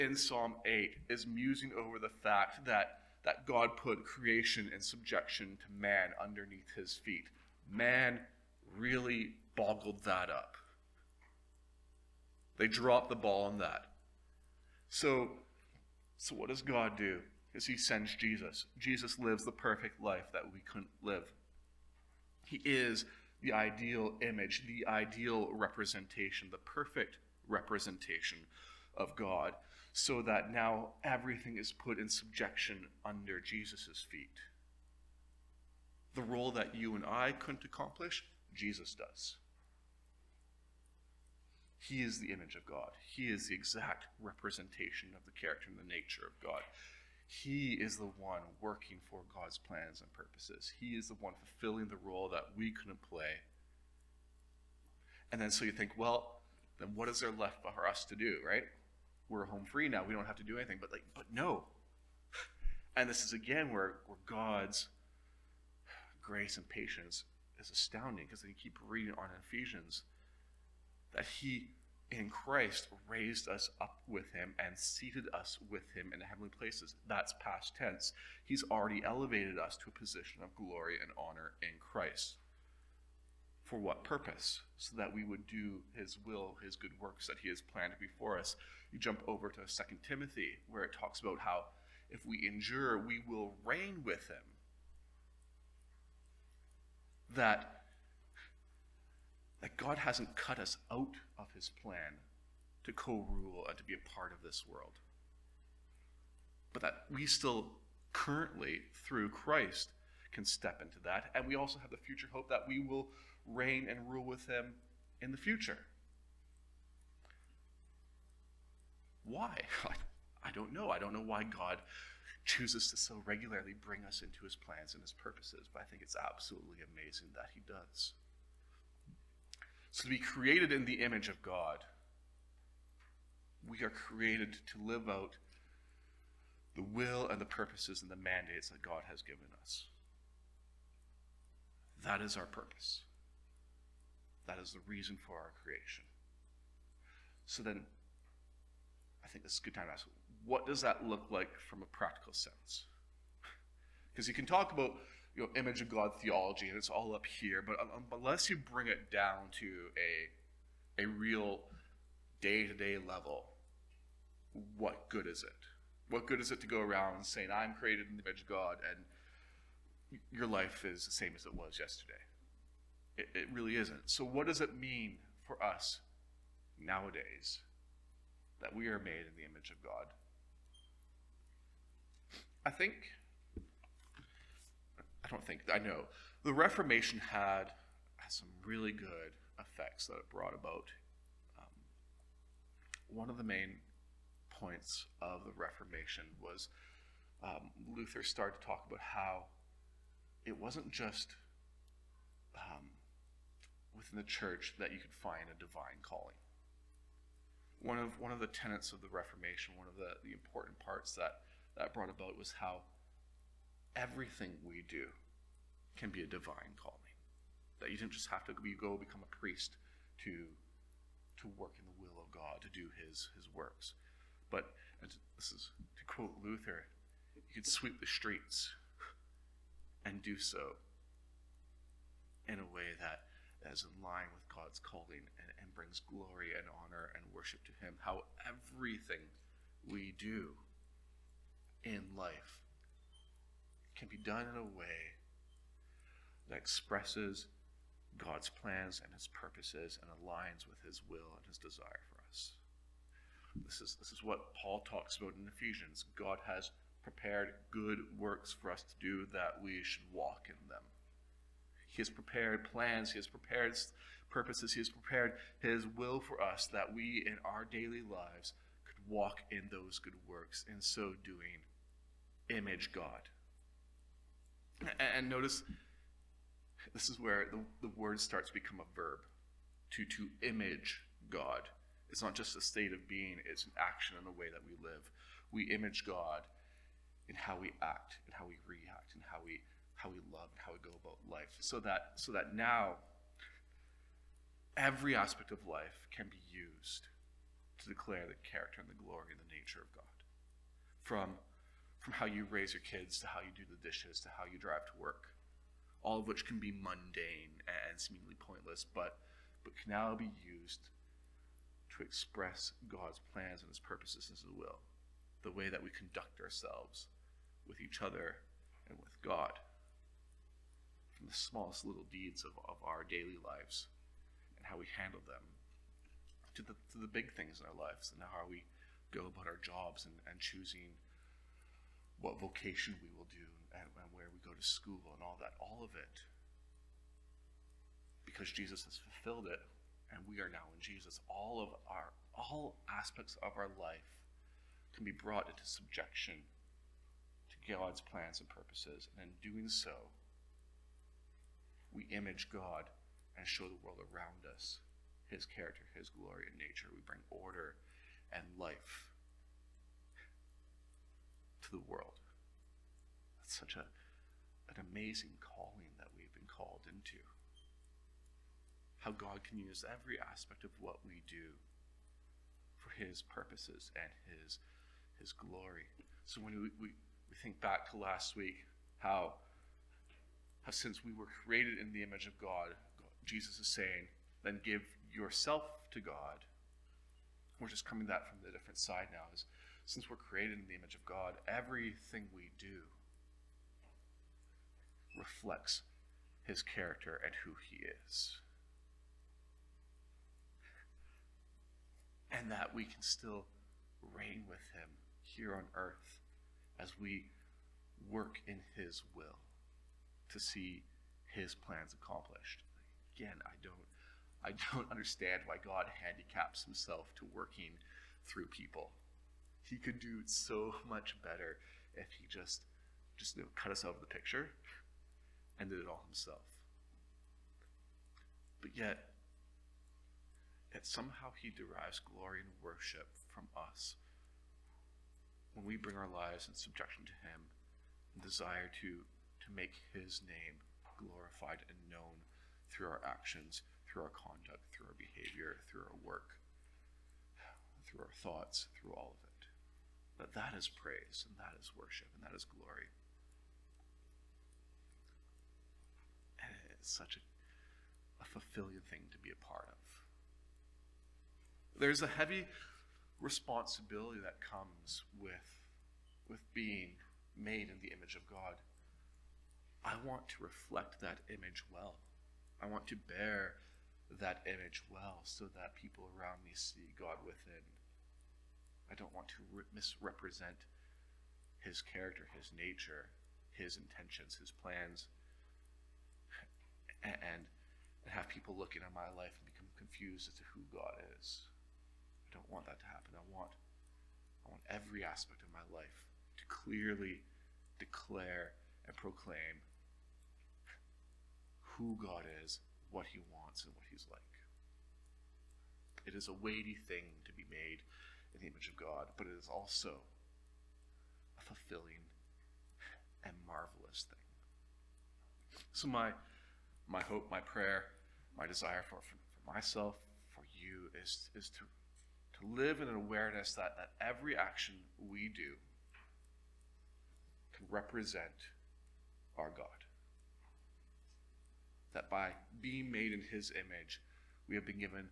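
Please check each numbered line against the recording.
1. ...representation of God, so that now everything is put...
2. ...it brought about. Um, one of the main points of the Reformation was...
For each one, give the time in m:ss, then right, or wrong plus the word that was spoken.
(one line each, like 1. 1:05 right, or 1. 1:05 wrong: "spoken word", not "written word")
1. 0:27 right
2. 3:10 right.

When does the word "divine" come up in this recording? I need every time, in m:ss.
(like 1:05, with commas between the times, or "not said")
3:25, 3:36.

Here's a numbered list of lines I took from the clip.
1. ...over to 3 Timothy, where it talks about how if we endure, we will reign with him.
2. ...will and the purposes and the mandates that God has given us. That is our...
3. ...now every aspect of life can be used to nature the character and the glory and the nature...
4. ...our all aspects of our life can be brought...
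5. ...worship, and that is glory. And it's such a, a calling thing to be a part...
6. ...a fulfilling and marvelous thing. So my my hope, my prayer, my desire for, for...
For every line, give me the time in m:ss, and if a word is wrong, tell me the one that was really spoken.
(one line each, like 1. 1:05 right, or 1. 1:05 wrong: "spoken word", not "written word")
1. 1:29 wrong: "2", not "3"
2. 2:16 right
3. 4:52 wrong: "declare", not "nature"
4. 5:41 right
5. 7:31 wrong: "fulfilling", not "calling"
6. 8:31 right.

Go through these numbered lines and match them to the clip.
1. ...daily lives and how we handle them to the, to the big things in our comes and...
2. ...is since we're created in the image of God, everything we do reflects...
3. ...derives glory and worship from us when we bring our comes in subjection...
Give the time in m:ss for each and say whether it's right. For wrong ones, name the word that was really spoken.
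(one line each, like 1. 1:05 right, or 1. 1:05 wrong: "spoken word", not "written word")
1. 5:23 wrong: "lives", not "comes"
2. 6:29 right
3. 7:11 wrong: "lives", not "comes".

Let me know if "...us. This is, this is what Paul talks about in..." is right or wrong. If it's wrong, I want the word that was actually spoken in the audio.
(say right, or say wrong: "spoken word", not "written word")
right.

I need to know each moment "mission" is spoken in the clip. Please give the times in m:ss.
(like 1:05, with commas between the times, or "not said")
not said.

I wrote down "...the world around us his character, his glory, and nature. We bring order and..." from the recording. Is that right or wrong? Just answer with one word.
right.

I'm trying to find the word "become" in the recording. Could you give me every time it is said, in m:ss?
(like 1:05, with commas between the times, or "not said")
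3:38, 4:38, 8:09.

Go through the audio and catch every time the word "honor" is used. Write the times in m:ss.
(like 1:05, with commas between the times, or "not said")
1:21, 3:56.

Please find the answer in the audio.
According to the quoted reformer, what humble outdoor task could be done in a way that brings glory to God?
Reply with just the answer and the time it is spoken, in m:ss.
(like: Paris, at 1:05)
Sweep the streets, at 3:47.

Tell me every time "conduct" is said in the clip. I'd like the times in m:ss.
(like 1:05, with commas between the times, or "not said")
5:15, 7:24.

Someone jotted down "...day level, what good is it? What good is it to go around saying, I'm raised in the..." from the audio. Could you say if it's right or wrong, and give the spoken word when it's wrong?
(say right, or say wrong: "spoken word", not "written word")
wrong: "created", not "raised".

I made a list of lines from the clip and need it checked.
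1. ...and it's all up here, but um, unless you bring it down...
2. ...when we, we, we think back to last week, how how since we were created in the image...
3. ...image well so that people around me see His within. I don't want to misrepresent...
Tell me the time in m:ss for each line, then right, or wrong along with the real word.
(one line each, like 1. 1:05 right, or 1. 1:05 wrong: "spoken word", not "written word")
1. 2:36 right
2. 6:16 right
3. 7:54 wrong: "God", not "His".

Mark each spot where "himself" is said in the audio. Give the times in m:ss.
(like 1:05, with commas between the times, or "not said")
6:56, 7:06.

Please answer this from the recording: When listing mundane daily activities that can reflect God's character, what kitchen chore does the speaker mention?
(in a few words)
The dishes.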